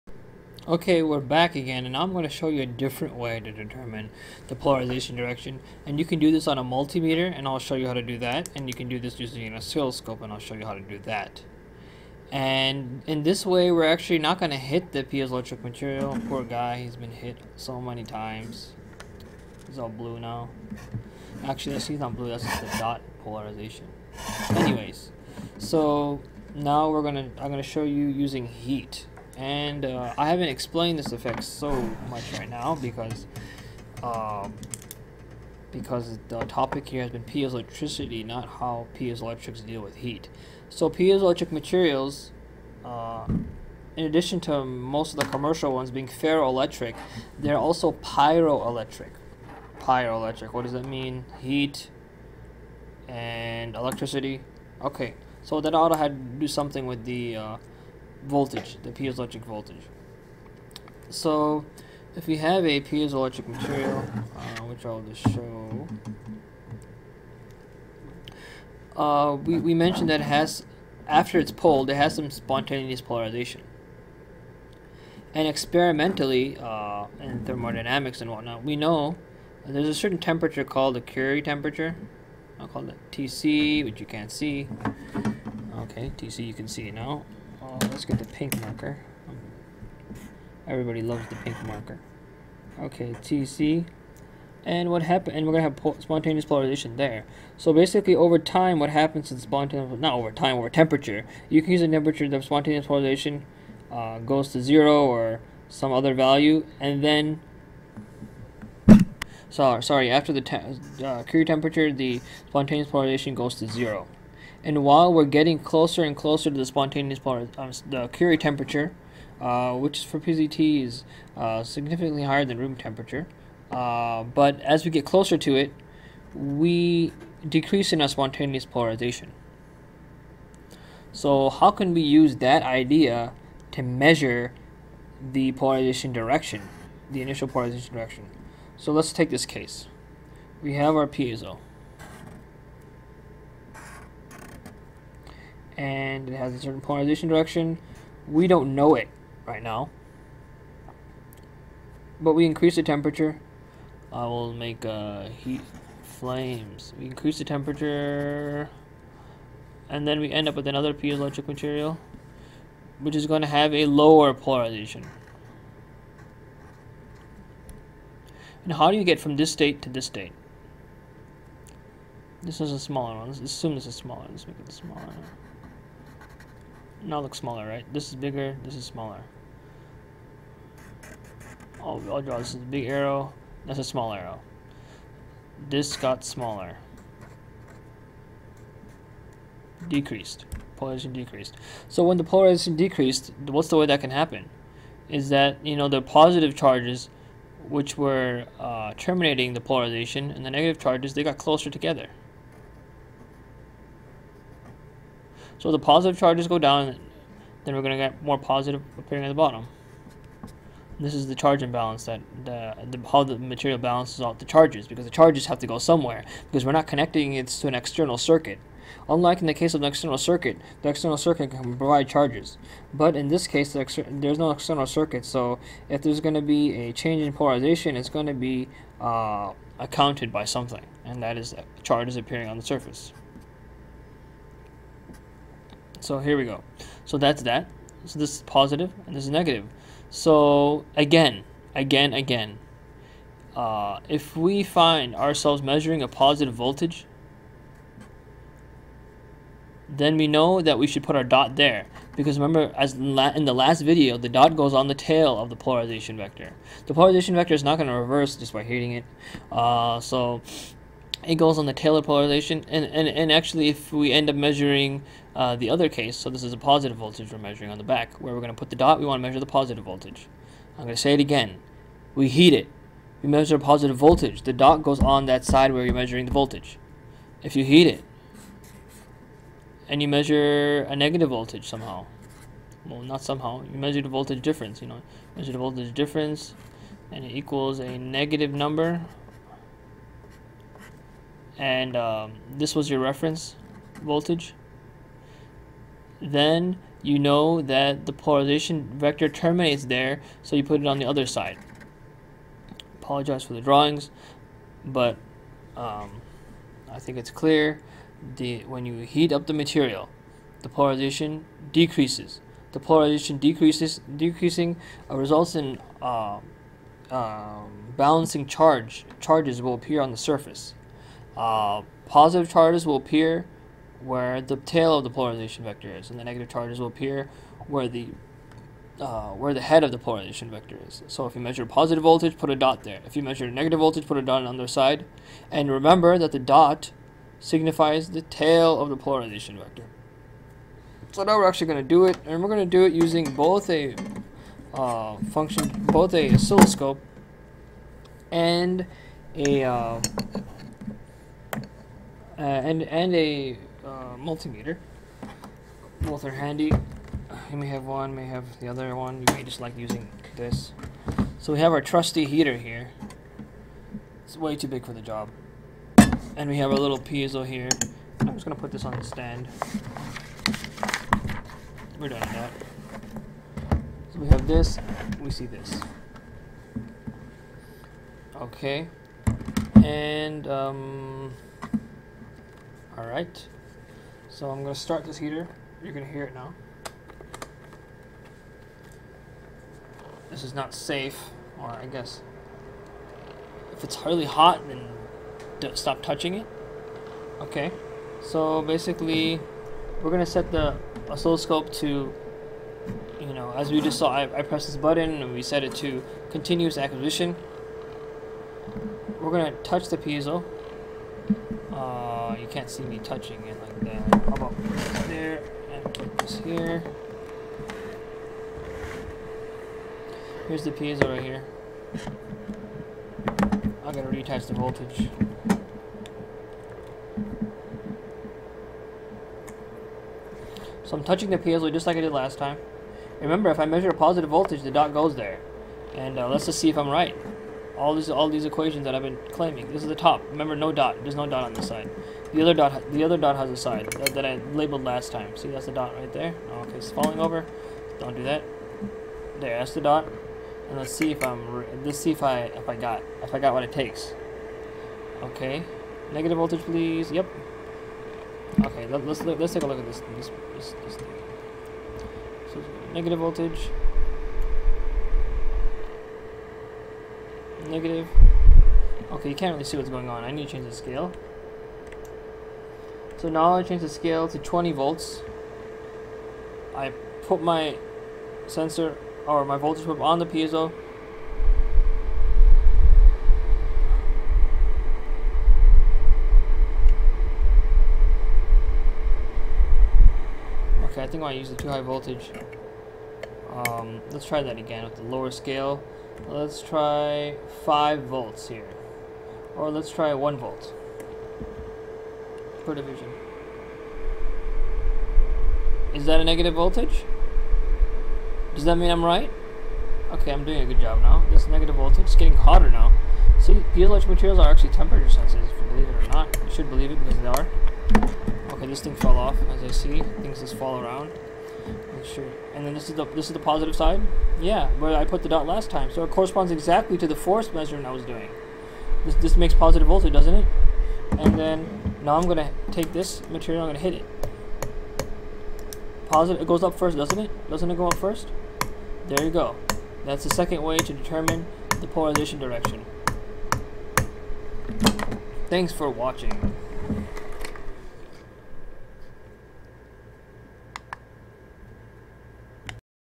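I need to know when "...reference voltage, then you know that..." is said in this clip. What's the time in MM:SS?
04:52.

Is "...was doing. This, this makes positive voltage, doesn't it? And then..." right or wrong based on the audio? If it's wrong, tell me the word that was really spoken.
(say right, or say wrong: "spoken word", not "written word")
right.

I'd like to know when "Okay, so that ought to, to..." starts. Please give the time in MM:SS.
00:54.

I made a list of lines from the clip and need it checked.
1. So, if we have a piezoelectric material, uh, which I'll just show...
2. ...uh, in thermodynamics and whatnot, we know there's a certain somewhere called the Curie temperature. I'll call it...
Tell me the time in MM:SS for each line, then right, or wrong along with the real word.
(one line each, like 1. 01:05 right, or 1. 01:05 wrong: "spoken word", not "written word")
1. 01:01 right
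2. 01:16 wrong: "temperature", not "somewhere".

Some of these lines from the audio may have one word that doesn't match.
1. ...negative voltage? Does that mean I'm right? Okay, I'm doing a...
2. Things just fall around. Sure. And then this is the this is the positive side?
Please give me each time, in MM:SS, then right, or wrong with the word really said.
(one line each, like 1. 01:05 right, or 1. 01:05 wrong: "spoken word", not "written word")
1. 08:26 right
2. 08:40 right.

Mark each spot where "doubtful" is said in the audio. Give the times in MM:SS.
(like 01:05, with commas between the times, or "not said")
not said.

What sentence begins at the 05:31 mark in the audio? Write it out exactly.
So if you measure positive voltage, put a dot there.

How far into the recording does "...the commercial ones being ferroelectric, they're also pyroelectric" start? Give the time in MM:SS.
00:45.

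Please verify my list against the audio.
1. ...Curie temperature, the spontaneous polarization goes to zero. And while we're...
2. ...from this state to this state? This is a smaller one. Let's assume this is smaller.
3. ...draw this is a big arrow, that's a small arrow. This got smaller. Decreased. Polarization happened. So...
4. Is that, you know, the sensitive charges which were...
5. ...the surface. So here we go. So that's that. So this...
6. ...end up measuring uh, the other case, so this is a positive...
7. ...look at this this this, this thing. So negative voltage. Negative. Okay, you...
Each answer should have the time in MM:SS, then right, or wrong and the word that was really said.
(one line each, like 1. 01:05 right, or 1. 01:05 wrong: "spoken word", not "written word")
1. 01:51 right
2. 02:49 right
3. 03:02 wrong: "decreased", not "happened"
4. 03:15 wrong: "positive", not "sensitive"
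5. 03:52 right
6. 04:24 right
7. 07:39 right.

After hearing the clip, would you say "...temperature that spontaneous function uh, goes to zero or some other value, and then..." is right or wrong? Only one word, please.
wrong.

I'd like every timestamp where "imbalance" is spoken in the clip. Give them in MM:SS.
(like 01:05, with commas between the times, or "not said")
03:31.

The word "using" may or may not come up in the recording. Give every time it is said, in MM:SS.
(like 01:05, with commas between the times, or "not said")
00:09, 00:28, 05:42, 05:59.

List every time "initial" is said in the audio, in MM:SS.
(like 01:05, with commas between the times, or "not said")
02:17.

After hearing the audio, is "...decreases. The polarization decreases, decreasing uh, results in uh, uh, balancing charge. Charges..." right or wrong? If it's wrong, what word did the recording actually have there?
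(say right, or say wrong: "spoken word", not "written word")
right.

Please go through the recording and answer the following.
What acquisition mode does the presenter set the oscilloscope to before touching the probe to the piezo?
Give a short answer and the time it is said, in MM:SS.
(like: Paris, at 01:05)
Continuous acquisition, at 06:46.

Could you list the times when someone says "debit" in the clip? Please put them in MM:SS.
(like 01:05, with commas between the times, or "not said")
not said.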